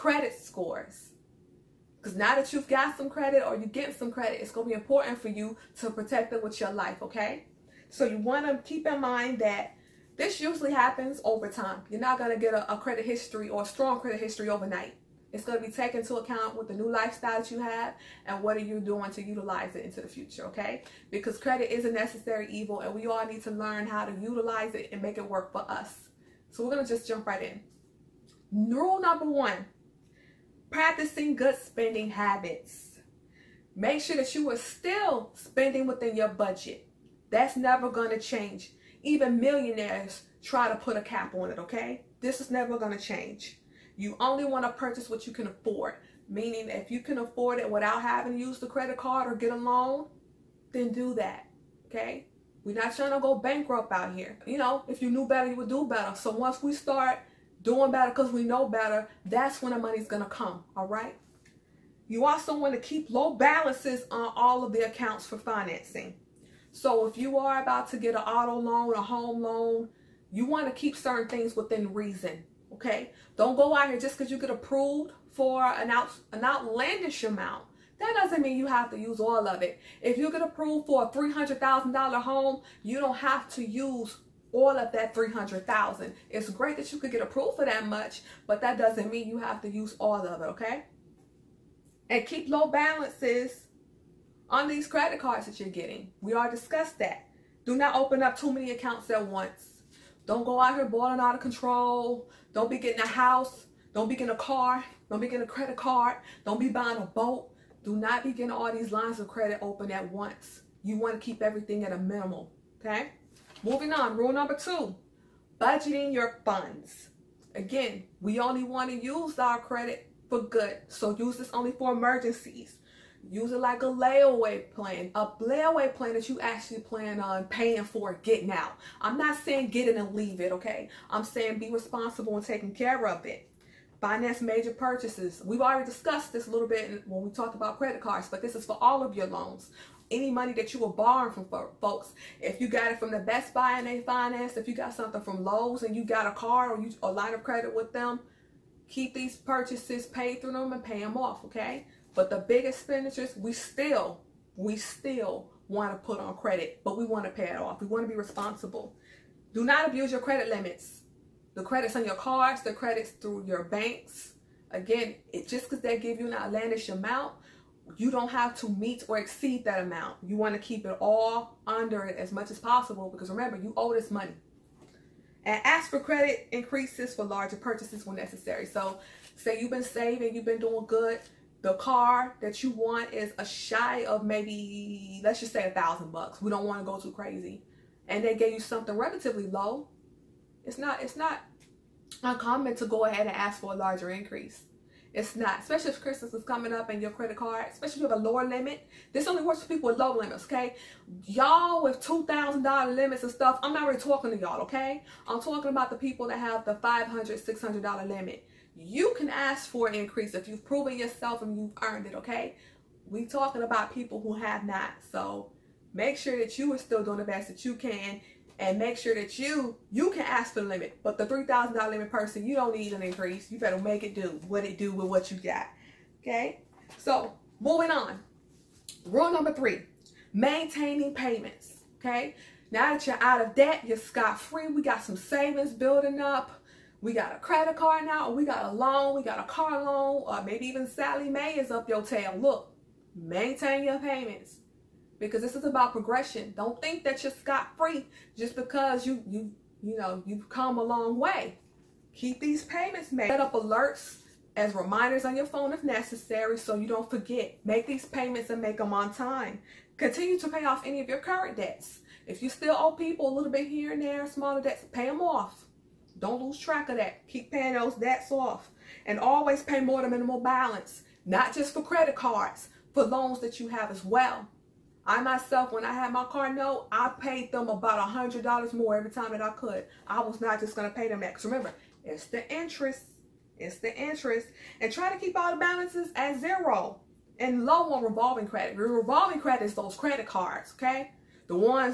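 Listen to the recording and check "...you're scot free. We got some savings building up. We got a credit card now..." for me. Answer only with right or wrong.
right.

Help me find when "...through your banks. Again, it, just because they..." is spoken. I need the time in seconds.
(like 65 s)
163 s.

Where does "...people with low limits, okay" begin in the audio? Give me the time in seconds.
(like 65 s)
199 s.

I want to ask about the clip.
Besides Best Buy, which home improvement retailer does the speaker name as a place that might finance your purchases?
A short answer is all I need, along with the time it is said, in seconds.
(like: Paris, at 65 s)
Lowe's, at 145 s.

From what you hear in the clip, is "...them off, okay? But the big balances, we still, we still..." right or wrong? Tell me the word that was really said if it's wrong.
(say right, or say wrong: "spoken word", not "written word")
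wrong: "expenditures", not "balances".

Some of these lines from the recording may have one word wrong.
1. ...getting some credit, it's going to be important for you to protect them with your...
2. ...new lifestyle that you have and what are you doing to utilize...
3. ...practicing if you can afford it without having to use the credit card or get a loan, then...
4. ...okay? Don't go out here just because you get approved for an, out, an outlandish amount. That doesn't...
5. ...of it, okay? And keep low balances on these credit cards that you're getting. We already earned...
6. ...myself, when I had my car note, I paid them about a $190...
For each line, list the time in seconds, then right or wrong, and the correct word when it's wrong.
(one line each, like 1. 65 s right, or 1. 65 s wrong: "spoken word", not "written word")
1. 3 s right
2. 16 s right
3. 46 s wrong: "meaning", not "practicing"
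4. 72 s right
5. 90 s wrong: "discussed", not "earned"
6. 275 s wrong: "100", not "190".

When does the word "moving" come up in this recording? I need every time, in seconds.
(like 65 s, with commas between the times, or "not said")
113 s, 227 s.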